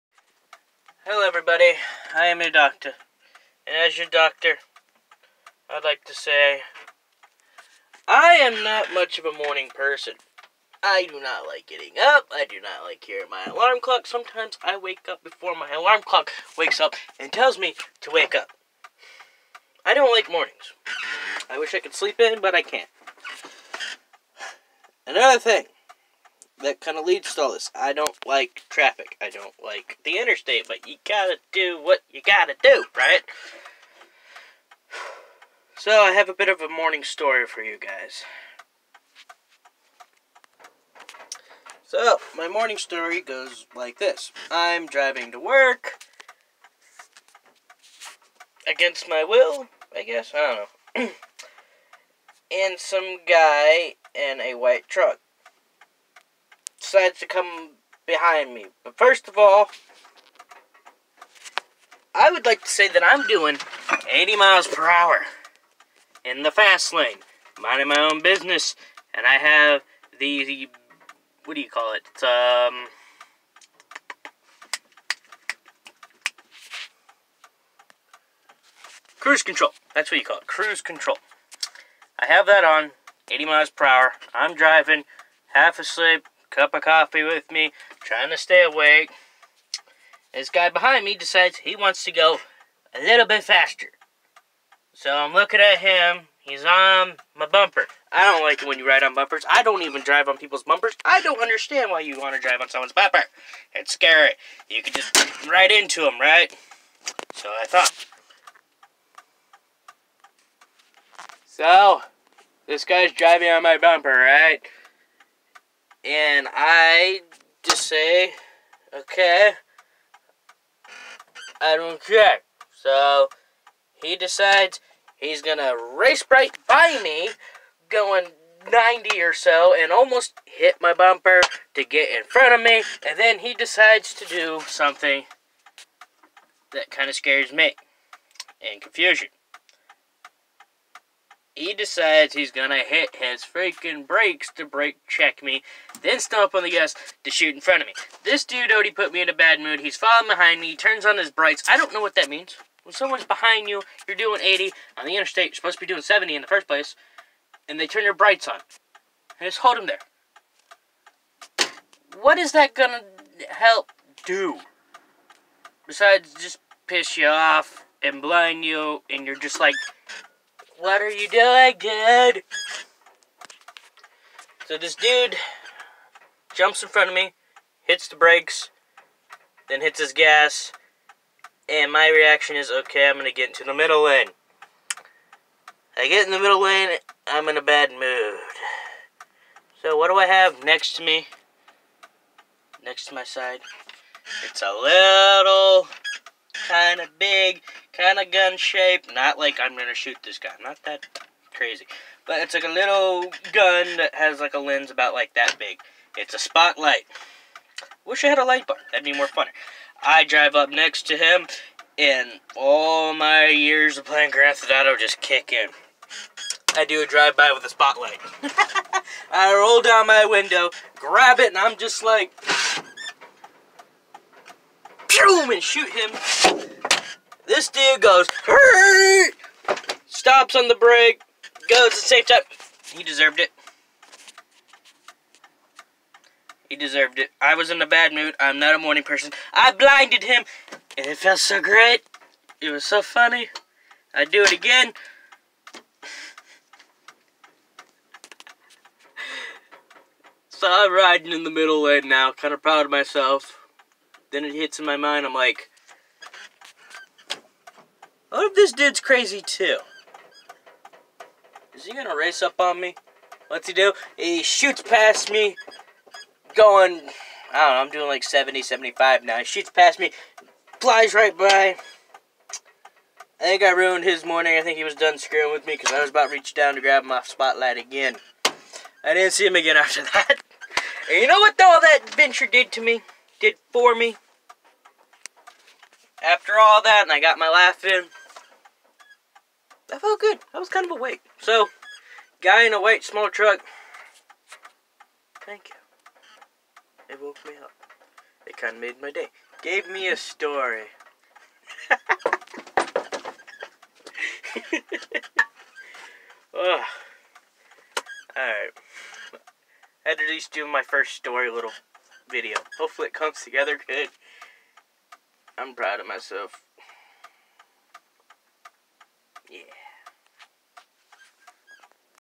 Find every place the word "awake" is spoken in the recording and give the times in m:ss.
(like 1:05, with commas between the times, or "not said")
1:28, 4:50.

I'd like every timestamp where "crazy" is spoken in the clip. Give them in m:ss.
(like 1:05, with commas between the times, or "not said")
3:21, 4:19.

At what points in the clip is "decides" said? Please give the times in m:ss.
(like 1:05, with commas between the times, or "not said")
0:56, 1:31, 2:04, 2:13, 2:21.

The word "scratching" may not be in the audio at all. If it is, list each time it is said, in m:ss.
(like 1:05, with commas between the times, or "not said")
not said.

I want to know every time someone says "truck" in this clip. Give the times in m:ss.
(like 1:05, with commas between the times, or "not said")
0:54, 4:53.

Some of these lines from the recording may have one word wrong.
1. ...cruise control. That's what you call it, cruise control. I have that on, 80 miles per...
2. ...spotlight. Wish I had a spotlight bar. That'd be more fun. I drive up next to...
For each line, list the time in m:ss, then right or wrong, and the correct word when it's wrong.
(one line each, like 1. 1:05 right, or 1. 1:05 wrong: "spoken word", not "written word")
1. 1:19 right
2. 3:26 wrong: "light", not "spotlight".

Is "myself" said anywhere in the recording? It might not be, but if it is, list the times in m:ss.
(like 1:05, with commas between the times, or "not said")
4:12, 5:16.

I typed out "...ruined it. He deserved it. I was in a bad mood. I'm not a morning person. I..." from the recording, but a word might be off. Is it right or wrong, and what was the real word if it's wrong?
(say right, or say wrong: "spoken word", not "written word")
wrong: "deserved", not "ruined".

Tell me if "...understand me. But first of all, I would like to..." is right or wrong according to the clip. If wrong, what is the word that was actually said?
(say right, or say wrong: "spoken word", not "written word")
wrong: "behind", not "understand".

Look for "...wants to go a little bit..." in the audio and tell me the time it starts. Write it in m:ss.
1:31.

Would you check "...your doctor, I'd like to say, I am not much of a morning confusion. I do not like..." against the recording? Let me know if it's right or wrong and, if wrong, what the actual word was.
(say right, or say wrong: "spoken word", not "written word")
wrong: "person", not "confusion".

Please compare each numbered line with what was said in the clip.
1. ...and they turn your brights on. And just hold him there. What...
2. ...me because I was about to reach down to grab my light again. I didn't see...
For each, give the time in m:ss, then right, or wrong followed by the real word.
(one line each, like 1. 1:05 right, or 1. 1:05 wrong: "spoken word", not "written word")
1. 2:37 right
2. 4:35 wrong: "spotlight", not "light".